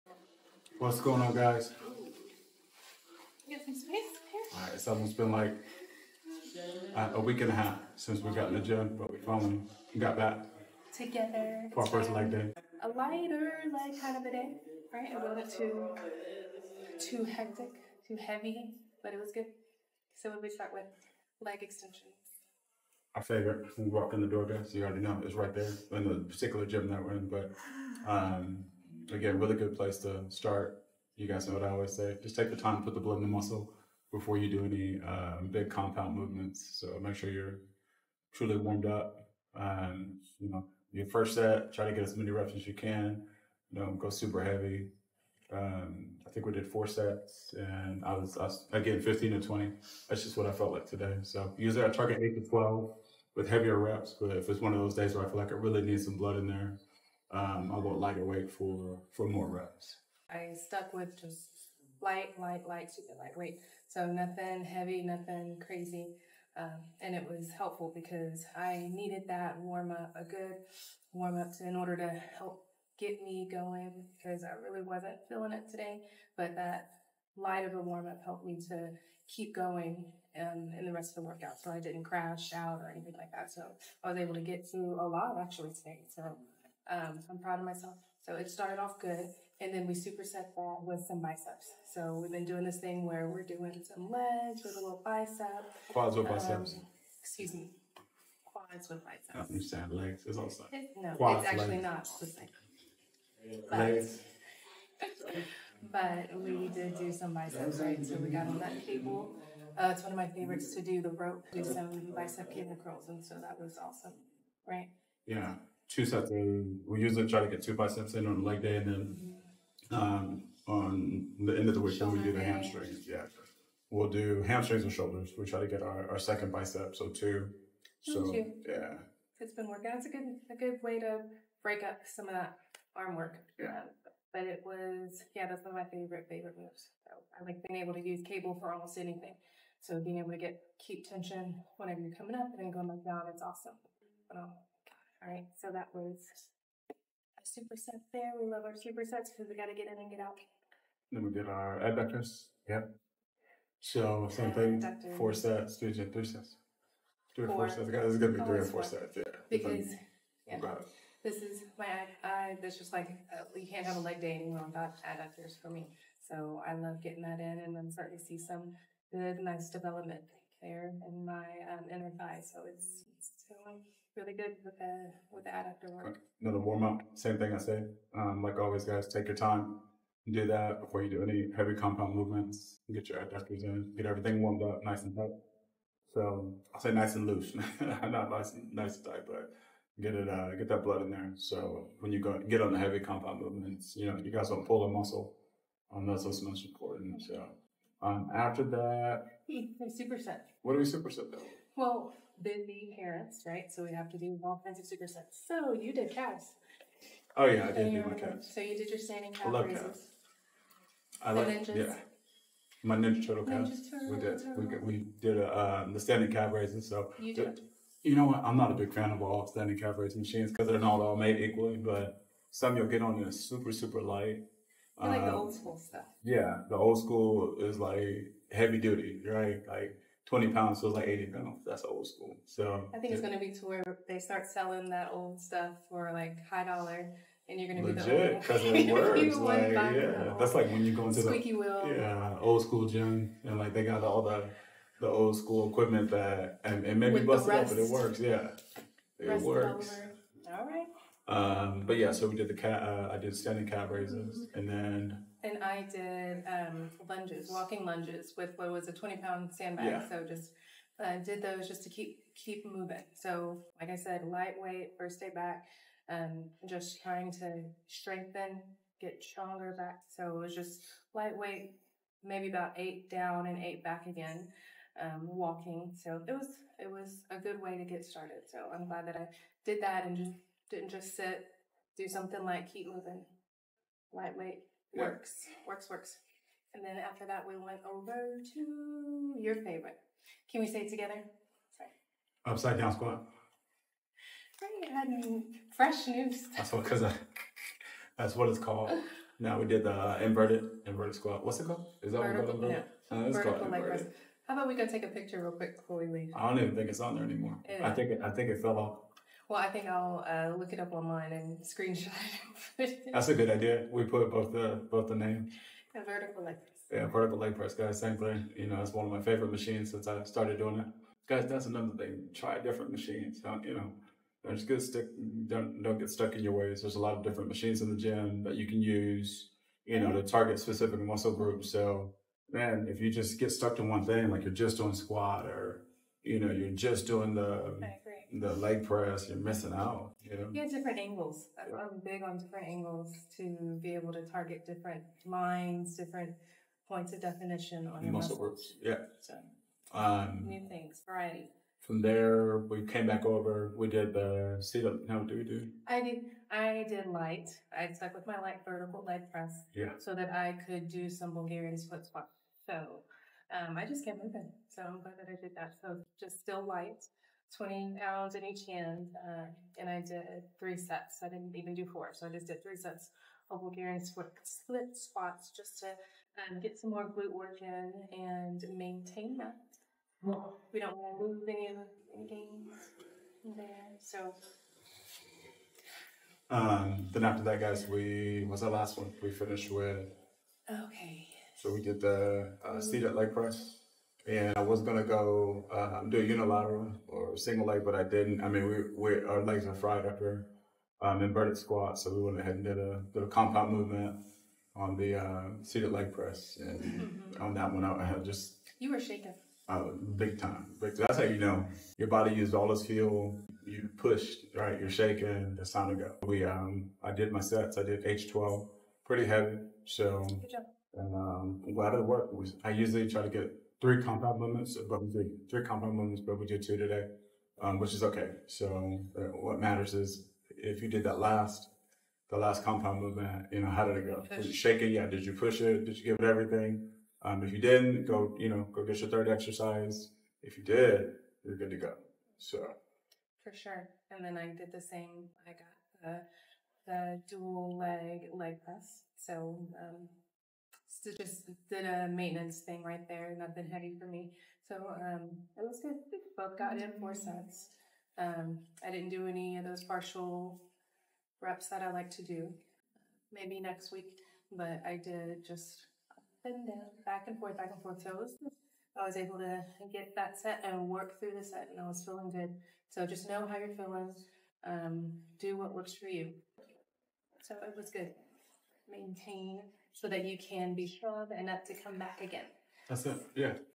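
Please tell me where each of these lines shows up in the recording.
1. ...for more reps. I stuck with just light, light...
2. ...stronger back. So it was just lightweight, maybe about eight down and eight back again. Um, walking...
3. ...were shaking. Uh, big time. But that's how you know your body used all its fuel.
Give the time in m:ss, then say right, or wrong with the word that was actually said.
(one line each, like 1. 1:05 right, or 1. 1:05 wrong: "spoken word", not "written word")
1. 0:59 right
2. 4:29 right
3. 6:48 right.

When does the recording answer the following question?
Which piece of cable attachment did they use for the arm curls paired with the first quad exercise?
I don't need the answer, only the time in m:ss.
1:51.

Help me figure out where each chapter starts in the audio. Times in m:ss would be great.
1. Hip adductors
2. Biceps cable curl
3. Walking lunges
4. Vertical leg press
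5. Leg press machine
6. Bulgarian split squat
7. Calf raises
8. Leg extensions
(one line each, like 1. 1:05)
1. 2:31
2. 1:30
3. 4:15
4. 4:47
5. 6:28
6. 5:53
7. 3:18
8. 0:21.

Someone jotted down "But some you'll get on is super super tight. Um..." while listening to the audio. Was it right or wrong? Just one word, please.
wrong.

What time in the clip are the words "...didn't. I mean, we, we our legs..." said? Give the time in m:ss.
6:38.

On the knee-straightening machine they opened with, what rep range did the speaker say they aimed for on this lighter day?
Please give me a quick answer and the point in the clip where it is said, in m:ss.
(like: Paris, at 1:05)
15 to 20, at 0:49.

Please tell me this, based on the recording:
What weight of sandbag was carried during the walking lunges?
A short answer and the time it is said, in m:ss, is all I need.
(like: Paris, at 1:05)
20 pounds, at 4:18.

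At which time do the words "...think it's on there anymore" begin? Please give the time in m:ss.
5:06.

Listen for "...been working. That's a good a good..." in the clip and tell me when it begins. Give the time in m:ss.
2:09.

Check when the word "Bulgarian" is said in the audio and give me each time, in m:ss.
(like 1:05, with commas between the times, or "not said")
6:01, 6:13.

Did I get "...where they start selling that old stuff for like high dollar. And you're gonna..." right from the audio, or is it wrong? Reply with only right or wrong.
right.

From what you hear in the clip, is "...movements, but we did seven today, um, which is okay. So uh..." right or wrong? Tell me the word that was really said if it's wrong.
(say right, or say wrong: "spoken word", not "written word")
wrong: "two", not "seven".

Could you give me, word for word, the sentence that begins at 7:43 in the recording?
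Maybe next week, but I did just up and down, back and forth, back and forth.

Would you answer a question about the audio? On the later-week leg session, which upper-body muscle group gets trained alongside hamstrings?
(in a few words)
Shoulders.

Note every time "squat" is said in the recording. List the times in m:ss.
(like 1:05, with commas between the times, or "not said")
4:52, 5:01, 5:34, 6:02, 6:14, 6:41.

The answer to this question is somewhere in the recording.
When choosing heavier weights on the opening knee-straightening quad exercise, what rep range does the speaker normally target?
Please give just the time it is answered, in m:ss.
0:52.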